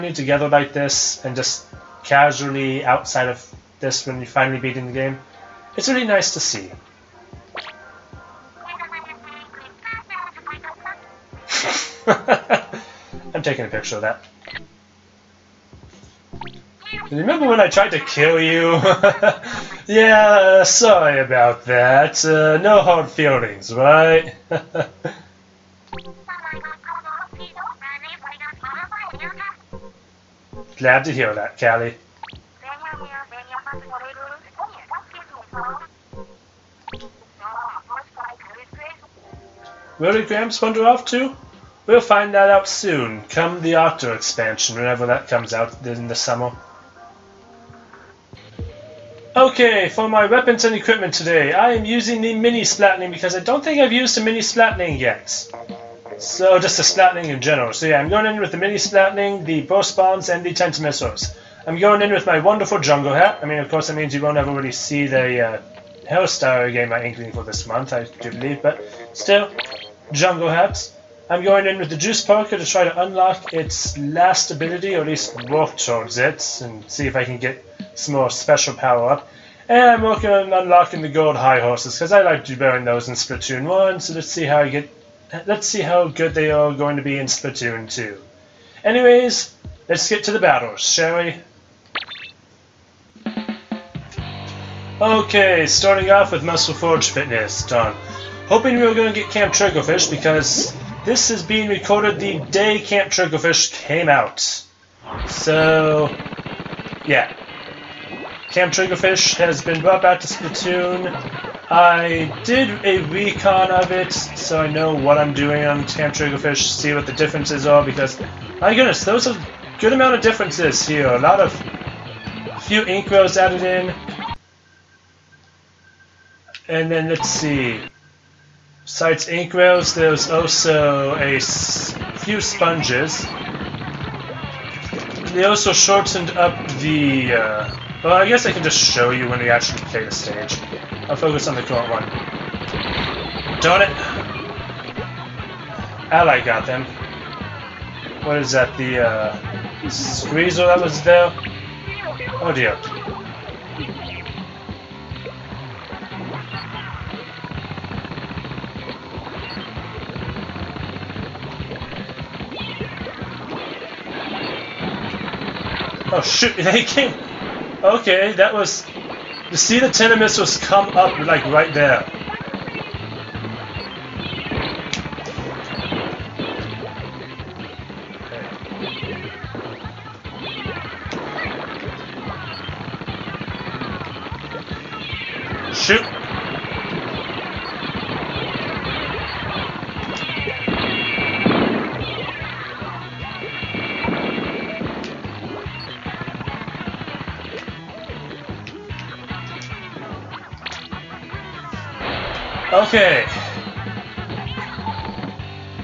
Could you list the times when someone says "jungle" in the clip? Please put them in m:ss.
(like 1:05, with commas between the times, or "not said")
1:02, 1:10.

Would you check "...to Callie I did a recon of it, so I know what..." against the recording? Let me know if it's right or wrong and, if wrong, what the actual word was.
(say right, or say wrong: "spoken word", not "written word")
wrong: "Splatoon", not "Callie".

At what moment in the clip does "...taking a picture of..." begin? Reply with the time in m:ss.
0:13.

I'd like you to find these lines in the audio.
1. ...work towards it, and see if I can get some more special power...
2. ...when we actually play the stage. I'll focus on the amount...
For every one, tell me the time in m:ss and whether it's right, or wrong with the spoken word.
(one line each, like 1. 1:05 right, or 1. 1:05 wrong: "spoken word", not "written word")
1. 1:15 right
2. 2:19 wrong: "current", not "amount".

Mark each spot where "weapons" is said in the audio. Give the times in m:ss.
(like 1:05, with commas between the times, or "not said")
0:50.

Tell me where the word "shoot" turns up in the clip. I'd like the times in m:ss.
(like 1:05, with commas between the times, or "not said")
2:46, 3:05.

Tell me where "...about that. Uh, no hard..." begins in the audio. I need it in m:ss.
0:21.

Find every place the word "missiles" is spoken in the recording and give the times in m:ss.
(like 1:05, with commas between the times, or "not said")
1:00, 2:50.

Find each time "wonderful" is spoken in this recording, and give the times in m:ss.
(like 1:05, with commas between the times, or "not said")
1:02.